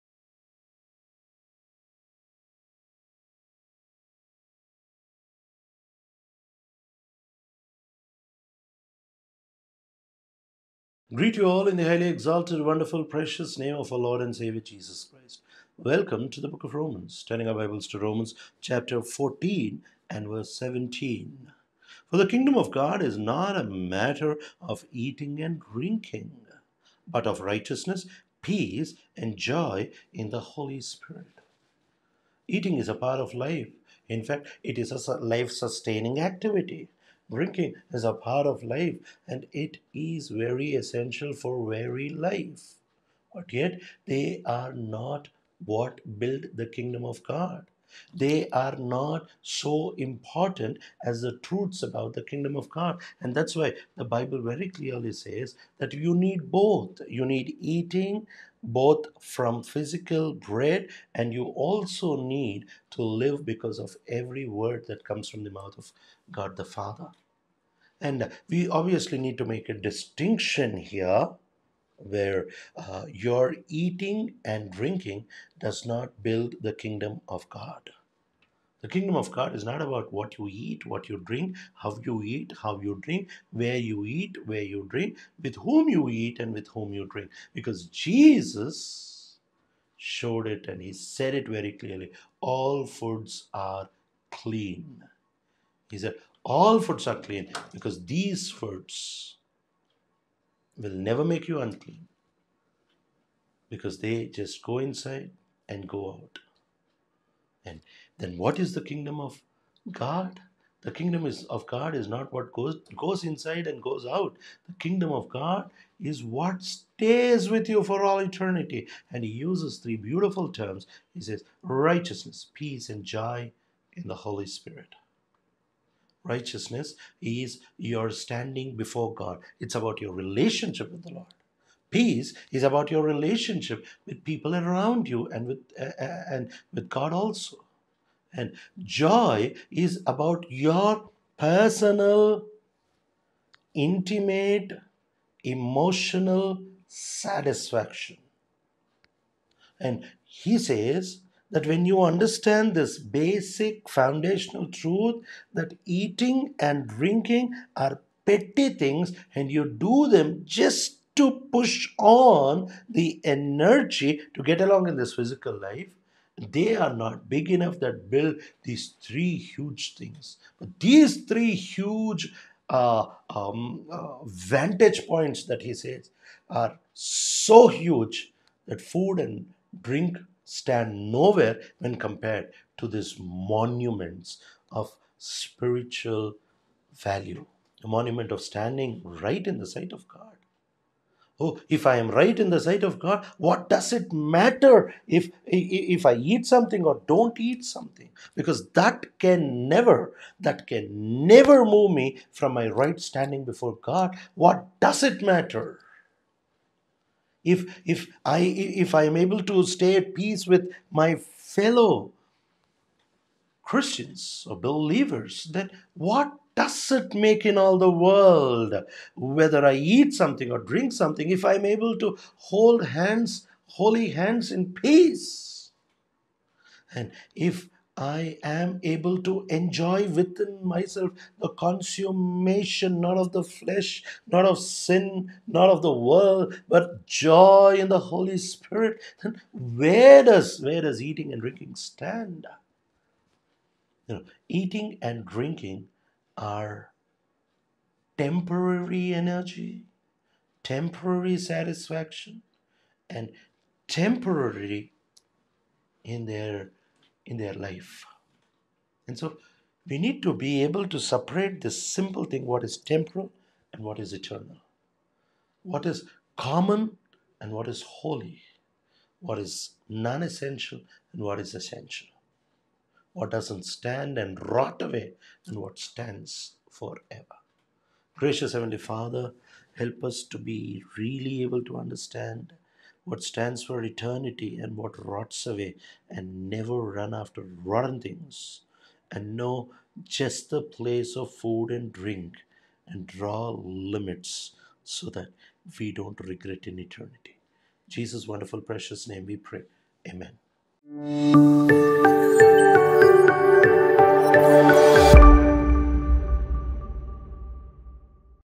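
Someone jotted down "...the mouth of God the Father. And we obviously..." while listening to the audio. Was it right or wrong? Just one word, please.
right.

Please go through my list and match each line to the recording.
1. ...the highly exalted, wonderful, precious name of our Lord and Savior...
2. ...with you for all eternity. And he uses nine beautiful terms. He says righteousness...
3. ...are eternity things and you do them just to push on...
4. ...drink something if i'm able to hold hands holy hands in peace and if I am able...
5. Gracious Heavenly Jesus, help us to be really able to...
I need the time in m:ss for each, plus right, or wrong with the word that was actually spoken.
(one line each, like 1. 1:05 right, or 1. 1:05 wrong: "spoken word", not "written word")
1. 0:11 right
2. 1:57 wrong: "three", not "nine"
3. 2:37 wrong: "petty", not "eternity"
4. 3:40 right
5. 4:38 wrong: "Father", not "Jesus".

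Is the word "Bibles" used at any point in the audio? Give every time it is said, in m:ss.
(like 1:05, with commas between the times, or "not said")
0:17, 0:54.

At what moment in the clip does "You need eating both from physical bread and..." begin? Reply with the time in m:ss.
0:57.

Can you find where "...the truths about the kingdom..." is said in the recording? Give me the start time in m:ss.
0:51.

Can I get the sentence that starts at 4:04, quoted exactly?
You know, eating and drinking are temporary energy, temporary satisfaction, and temporary in their in their life.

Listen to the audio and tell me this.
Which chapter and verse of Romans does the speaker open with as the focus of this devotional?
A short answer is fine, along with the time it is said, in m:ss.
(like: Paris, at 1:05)
14:17, at 0:18.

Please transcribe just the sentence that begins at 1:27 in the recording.
Because Jesus showed it and he said it very clearly all foods are clean.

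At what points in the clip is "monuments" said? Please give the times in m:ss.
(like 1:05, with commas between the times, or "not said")
3:03, 3:07.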